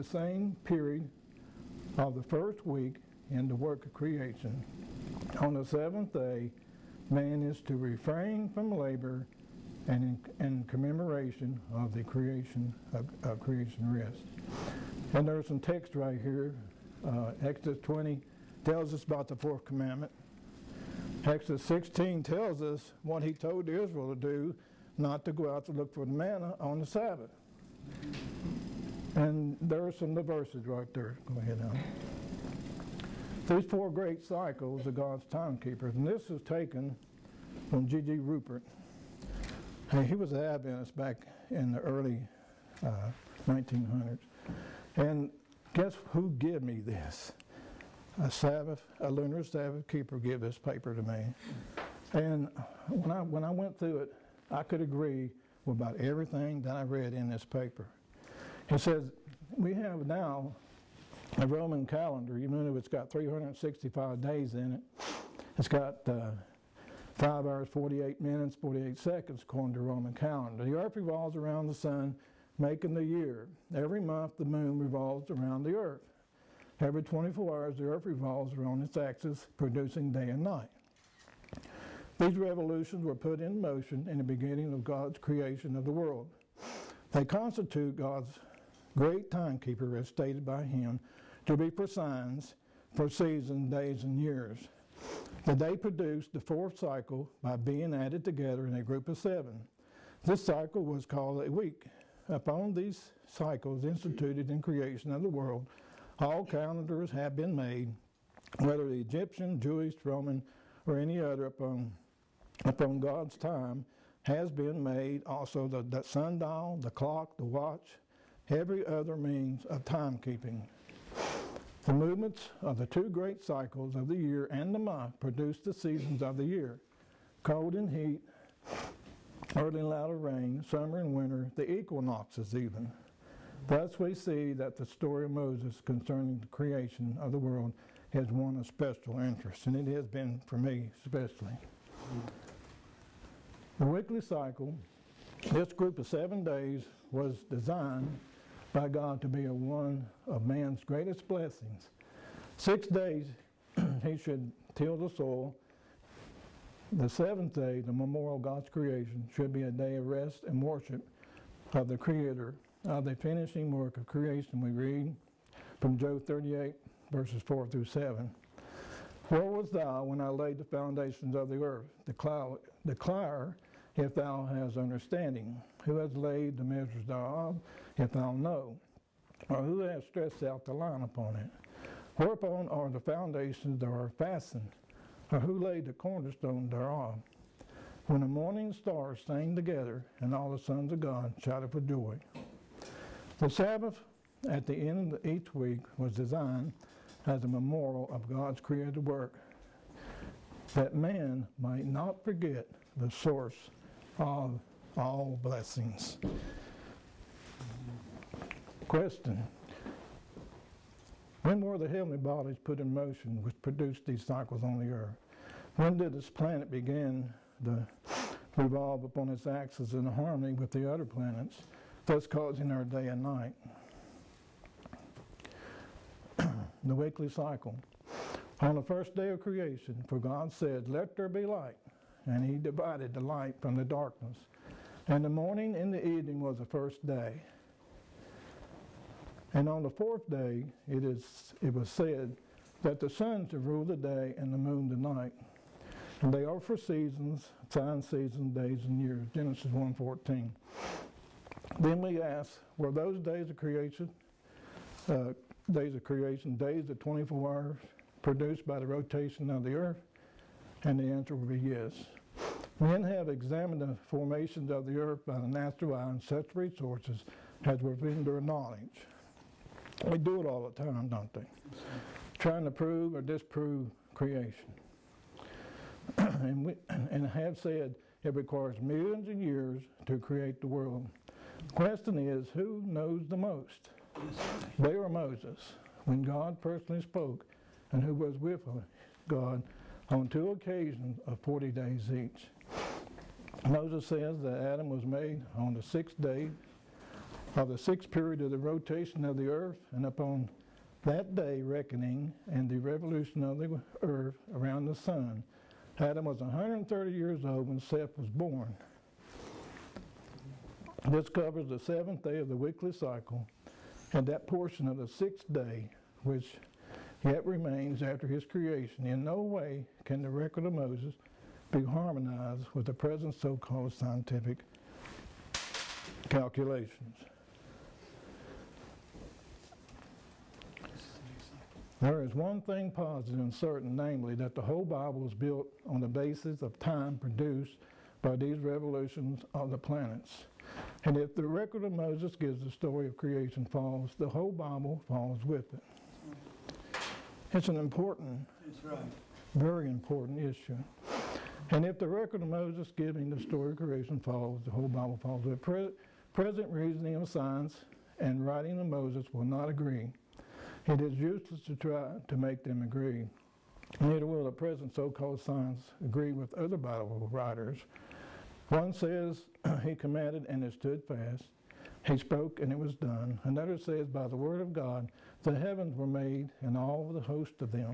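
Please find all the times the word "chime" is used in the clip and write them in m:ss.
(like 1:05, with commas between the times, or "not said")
not said.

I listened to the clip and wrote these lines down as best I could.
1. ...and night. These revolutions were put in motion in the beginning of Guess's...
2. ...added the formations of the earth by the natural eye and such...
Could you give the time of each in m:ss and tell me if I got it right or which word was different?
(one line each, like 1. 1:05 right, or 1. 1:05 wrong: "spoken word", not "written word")
1. 1:20 wrong: "God", not "Guess"
2. 4:23 wrong: "examined", not "added".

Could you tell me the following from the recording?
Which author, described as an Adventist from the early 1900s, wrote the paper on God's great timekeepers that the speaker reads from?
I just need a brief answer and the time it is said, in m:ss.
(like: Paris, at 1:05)
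G.G. Rupert, at 0:37.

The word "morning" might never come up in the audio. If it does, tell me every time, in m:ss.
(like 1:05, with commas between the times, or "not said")
3:08, 3:55.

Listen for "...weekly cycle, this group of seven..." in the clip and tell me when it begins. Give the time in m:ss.
2:23.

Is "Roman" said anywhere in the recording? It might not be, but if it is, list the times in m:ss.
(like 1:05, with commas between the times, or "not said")
1:01, 1:09, 1:50.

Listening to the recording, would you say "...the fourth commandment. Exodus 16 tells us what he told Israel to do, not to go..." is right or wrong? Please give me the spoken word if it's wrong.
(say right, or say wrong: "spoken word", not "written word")
right.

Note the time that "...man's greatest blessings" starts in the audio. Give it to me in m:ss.
2:30.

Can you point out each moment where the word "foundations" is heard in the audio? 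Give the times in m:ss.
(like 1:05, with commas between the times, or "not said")
2:50, 3:02.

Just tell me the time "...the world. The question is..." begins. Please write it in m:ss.
4:40.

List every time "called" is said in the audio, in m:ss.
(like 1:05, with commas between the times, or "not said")
1:41, 5:23, 6:04.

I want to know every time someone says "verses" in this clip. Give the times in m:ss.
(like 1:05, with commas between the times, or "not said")
0:30, 2:47.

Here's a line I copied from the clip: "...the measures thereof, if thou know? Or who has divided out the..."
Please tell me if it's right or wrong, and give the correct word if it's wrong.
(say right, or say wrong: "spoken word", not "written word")
wrong: "stretched", not "divided".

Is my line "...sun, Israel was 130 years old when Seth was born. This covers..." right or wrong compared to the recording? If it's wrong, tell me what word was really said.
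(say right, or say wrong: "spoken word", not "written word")
wrong: "Adam", not "Israel".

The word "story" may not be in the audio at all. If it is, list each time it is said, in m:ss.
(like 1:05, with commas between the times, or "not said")
2:14, 5:42, 5:53.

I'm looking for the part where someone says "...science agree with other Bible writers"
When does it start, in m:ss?
6:05.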